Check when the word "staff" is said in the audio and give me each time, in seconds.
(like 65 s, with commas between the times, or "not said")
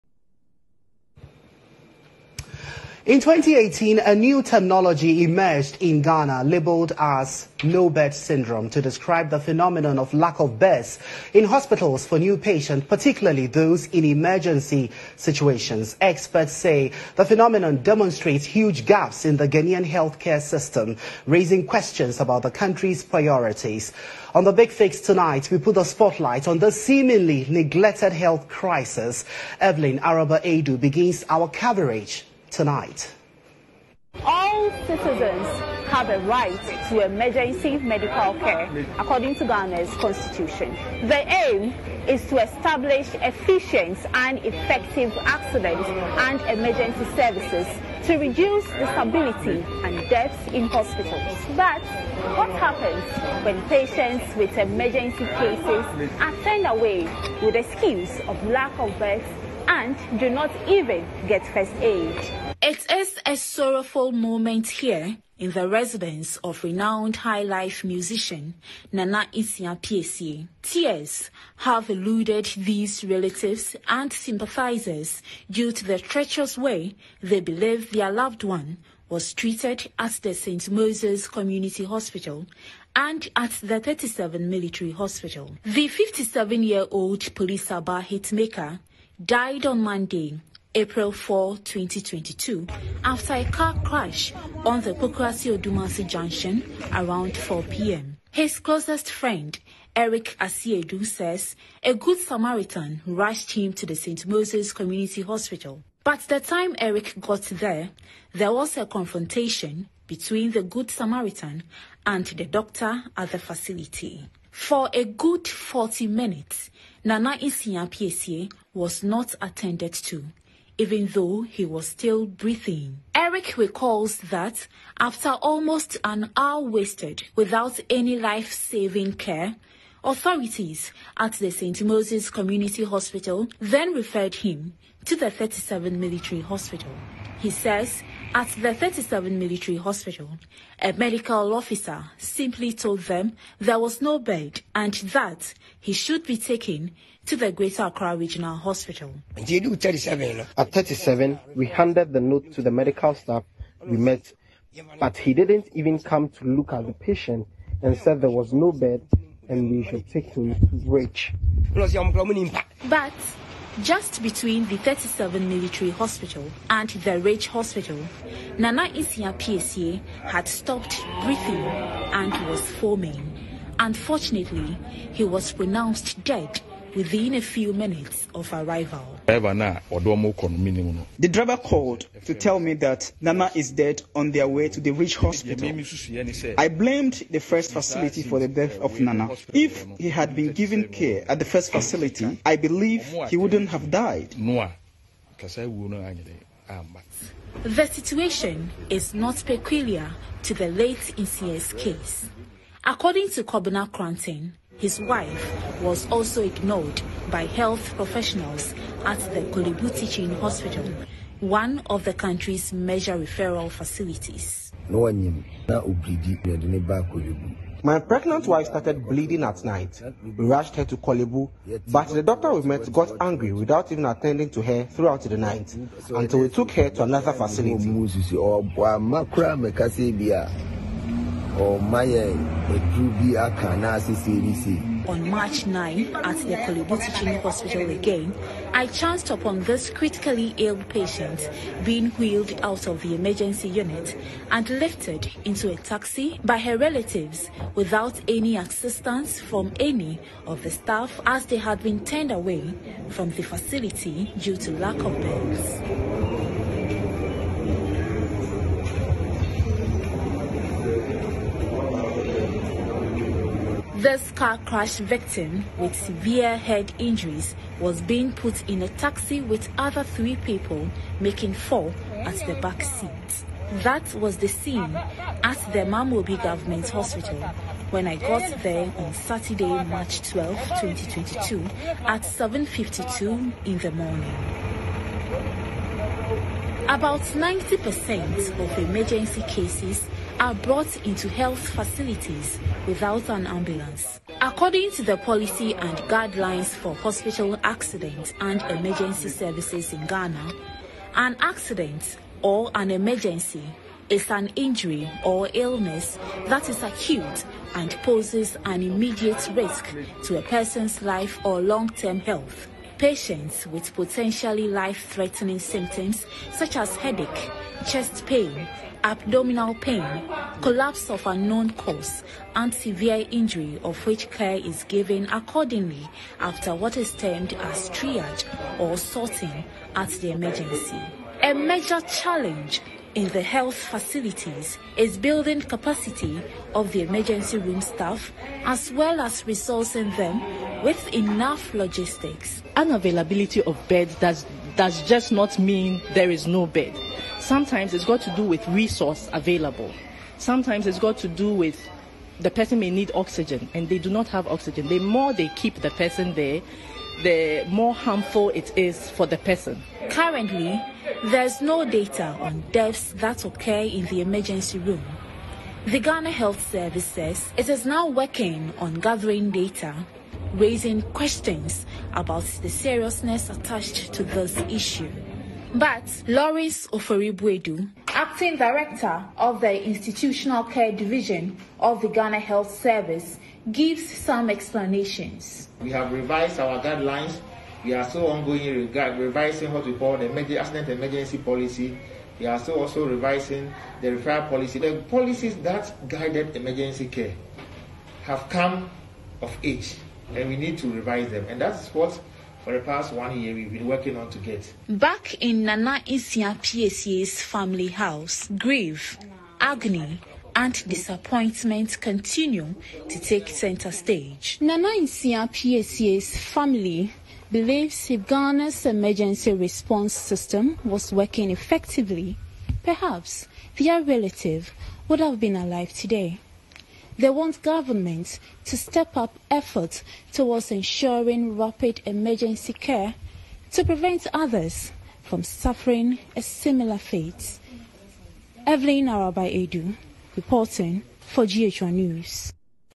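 153 s, 250 s, 337 s.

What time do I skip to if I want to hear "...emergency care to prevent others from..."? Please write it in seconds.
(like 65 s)
432 s.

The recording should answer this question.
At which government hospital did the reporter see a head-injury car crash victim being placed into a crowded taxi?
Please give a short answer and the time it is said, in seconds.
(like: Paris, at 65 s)
Mamobi Government Hospital, at 275 s.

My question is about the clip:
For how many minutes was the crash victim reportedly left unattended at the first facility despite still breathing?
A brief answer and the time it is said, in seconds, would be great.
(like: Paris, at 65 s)
40, at 115 s.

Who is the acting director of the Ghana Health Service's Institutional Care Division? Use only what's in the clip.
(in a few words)
Lawrence Ofori-Boadu.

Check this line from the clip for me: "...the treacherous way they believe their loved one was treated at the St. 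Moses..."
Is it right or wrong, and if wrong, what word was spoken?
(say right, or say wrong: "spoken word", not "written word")
right.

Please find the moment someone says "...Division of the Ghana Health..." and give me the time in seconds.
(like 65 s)
380 s.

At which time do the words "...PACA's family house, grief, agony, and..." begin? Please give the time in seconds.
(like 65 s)
406 s.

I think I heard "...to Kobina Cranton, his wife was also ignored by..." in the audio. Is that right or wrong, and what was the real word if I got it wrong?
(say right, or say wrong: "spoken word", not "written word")
right.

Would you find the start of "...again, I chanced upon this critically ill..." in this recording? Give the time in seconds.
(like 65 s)
237 s.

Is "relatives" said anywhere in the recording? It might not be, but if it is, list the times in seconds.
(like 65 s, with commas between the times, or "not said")
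73 s, 246 s, 424 s.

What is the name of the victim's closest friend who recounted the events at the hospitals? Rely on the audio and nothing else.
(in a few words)
Eric Asiedu.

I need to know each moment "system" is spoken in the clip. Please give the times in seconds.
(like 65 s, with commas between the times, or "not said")
20 s, 420 s.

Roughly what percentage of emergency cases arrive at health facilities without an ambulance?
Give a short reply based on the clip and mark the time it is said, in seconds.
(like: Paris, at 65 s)
90%, at 287 s.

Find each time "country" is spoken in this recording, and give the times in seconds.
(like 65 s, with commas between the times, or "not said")
22 s, 212 s.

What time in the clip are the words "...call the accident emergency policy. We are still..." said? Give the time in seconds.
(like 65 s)
389 s.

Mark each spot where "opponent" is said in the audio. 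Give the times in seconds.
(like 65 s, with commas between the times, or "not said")
not said.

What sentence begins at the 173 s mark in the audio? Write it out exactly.
Unfortunately, he was pronounced dead within a few minutes of arrival.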